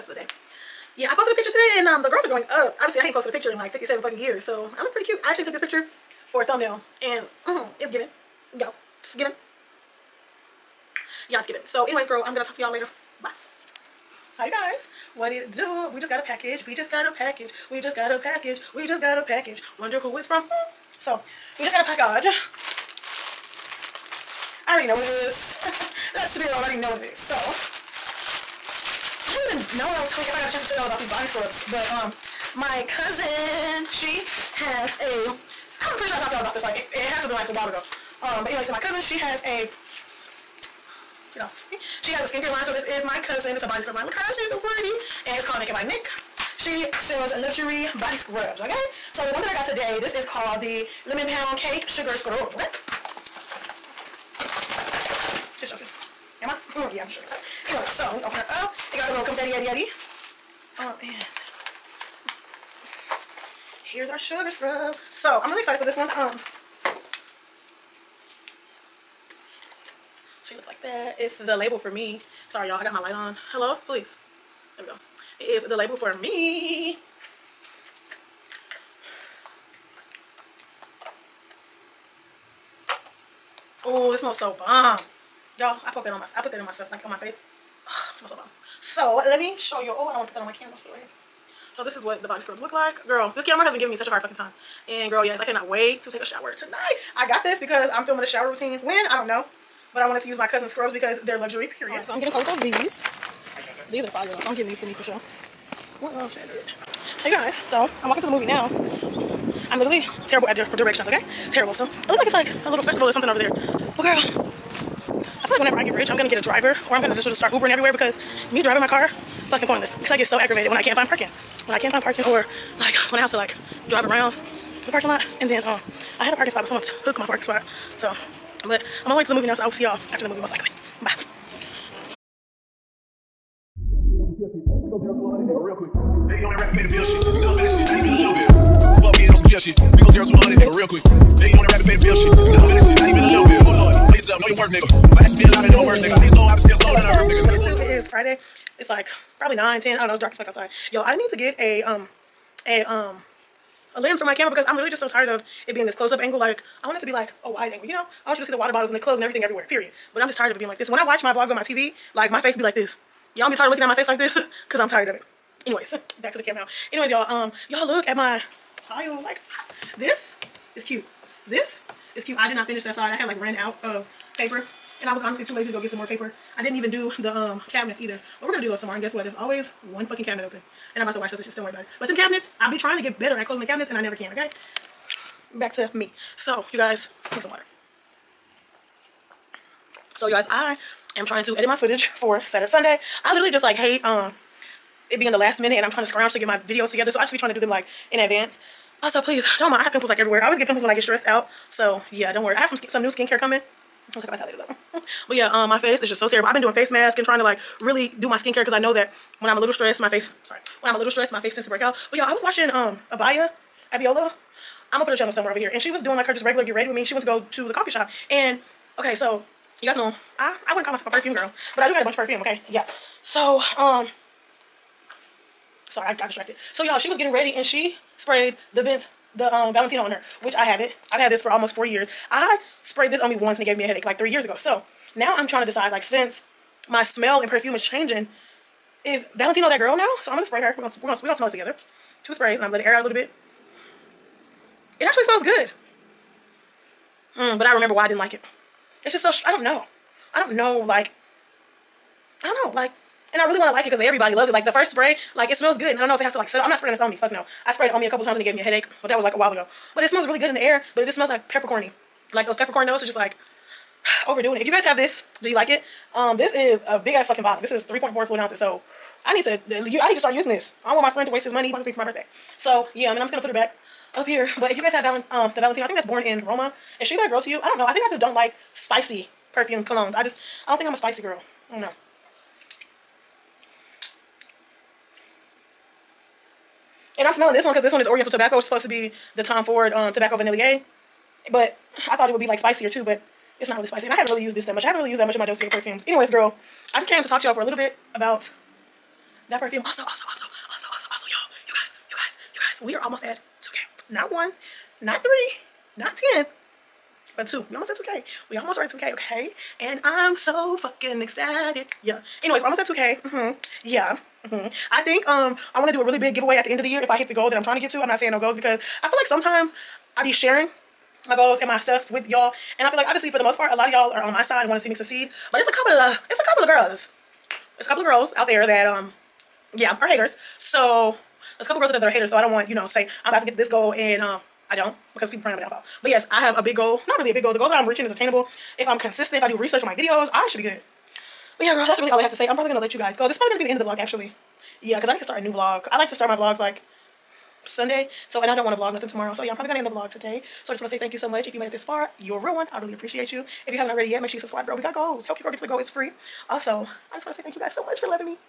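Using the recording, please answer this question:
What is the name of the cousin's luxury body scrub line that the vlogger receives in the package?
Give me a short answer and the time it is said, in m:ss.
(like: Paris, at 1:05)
Naked by Nik, at 0:45.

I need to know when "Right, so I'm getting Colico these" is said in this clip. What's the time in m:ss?
1:41.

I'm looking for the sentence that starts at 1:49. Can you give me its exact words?
I'm literally terrible at directions, okay?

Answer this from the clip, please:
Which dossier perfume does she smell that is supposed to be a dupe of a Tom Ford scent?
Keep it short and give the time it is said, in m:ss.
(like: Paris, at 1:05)
Oriental Tobacco, at 4:48.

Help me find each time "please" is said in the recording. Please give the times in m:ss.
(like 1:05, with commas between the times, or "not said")
1:13, 3:19.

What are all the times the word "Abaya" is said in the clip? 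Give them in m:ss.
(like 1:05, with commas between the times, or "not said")
3:33.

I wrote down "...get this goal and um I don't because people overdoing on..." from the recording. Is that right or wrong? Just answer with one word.
wrong.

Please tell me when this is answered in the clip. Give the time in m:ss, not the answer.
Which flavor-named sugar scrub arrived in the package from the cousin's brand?
0:51.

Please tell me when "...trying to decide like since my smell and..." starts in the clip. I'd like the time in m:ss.
3:55.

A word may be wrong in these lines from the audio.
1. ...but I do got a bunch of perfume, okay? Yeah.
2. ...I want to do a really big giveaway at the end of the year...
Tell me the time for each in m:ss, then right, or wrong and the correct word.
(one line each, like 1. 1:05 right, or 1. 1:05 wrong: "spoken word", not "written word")
1. 3:41 right
2. 5:15 right.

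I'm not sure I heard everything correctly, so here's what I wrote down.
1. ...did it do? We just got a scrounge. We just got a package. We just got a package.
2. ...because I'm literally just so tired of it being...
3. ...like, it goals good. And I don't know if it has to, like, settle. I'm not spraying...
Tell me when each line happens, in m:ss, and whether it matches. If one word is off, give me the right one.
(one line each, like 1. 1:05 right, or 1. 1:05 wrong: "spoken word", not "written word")
1. 0:15 wrong: "package", not "scrounge"
2. 2:34 right
3. 4:15 wrong: "smells", not "goals".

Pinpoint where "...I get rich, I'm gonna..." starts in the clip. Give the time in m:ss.
1:55.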